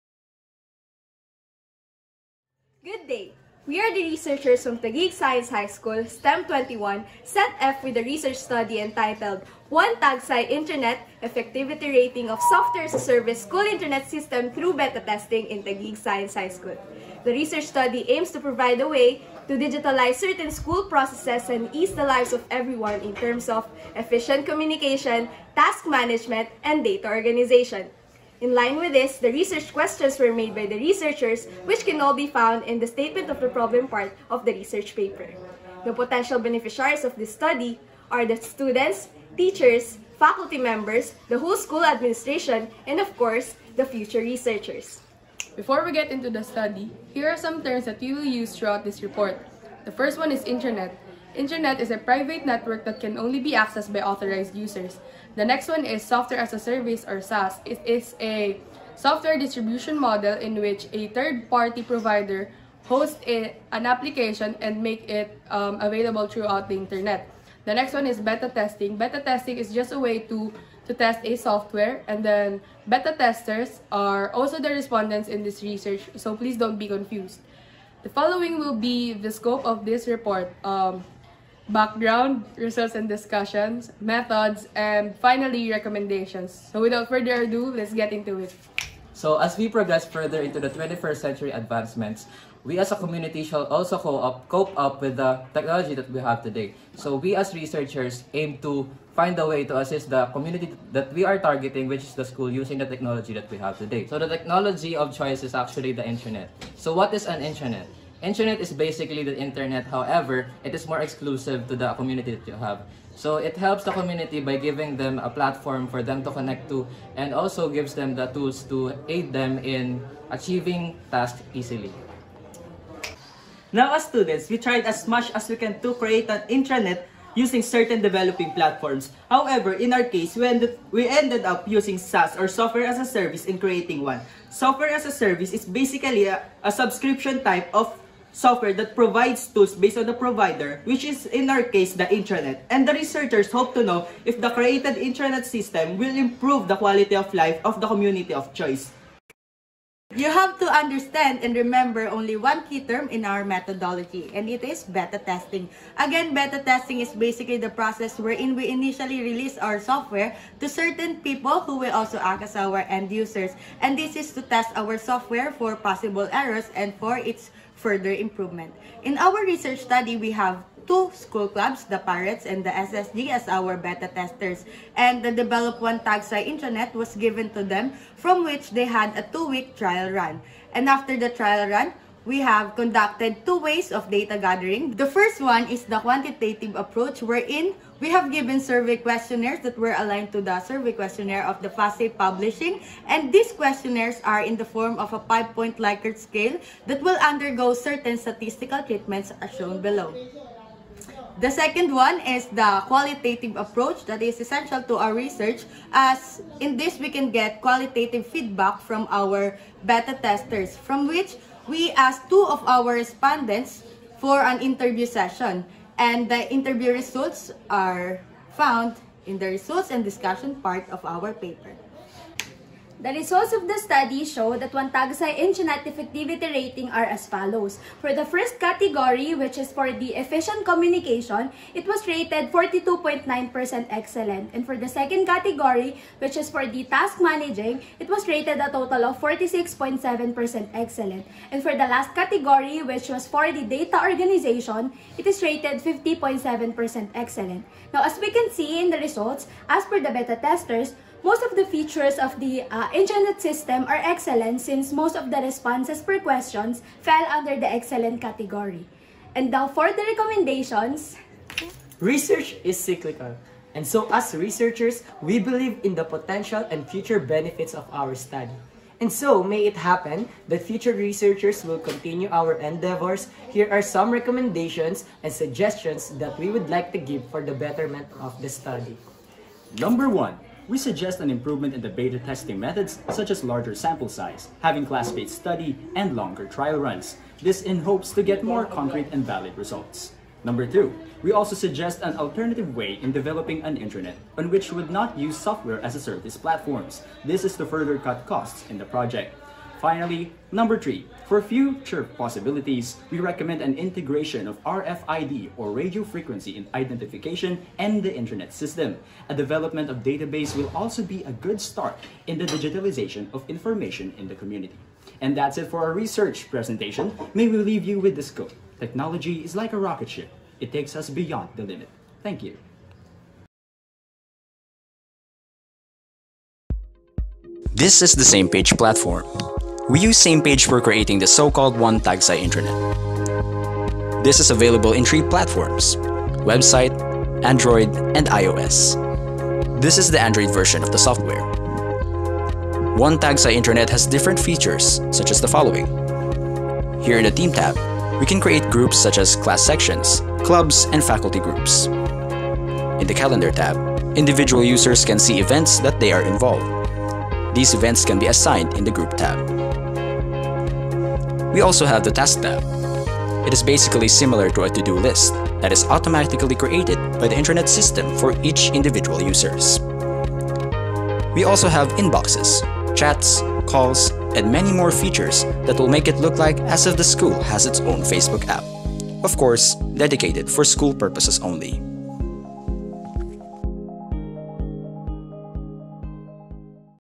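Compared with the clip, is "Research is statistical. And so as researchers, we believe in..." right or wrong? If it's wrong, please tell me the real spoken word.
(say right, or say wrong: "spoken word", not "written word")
wrong: "cyclical", not "statistical".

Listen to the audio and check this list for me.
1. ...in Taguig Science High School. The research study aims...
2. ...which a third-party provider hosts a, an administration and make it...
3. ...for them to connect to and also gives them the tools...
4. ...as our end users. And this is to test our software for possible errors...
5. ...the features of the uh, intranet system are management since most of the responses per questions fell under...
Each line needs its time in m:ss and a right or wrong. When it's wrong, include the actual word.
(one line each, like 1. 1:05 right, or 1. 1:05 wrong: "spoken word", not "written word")
1. 0:15 right
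2. 1:00 wrong: "application", not "administration"
3. 1:55 right
4. 2:42 right
5. 4:11 wrong: "excellent", not "management".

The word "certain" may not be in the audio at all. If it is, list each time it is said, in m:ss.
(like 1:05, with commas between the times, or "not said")
0:20, 2:07, 2:40, 3:17.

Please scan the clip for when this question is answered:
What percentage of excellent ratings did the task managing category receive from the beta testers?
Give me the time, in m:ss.
3:59.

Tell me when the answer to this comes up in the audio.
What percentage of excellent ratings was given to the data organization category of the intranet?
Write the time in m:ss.
4:05.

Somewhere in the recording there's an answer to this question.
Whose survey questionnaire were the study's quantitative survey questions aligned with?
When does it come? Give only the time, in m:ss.
3:11.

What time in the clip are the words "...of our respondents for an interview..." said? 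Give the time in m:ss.
3:32.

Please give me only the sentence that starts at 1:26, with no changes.
So without further ado, let's get into it.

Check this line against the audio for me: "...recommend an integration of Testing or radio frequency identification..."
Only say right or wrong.
wrong.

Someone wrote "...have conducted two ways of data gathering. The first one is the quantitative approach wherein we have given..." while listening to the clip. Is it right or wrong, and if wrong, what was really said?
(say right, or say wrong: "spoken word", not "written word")
right.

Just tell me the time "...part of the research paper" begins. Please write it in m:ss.
0:33.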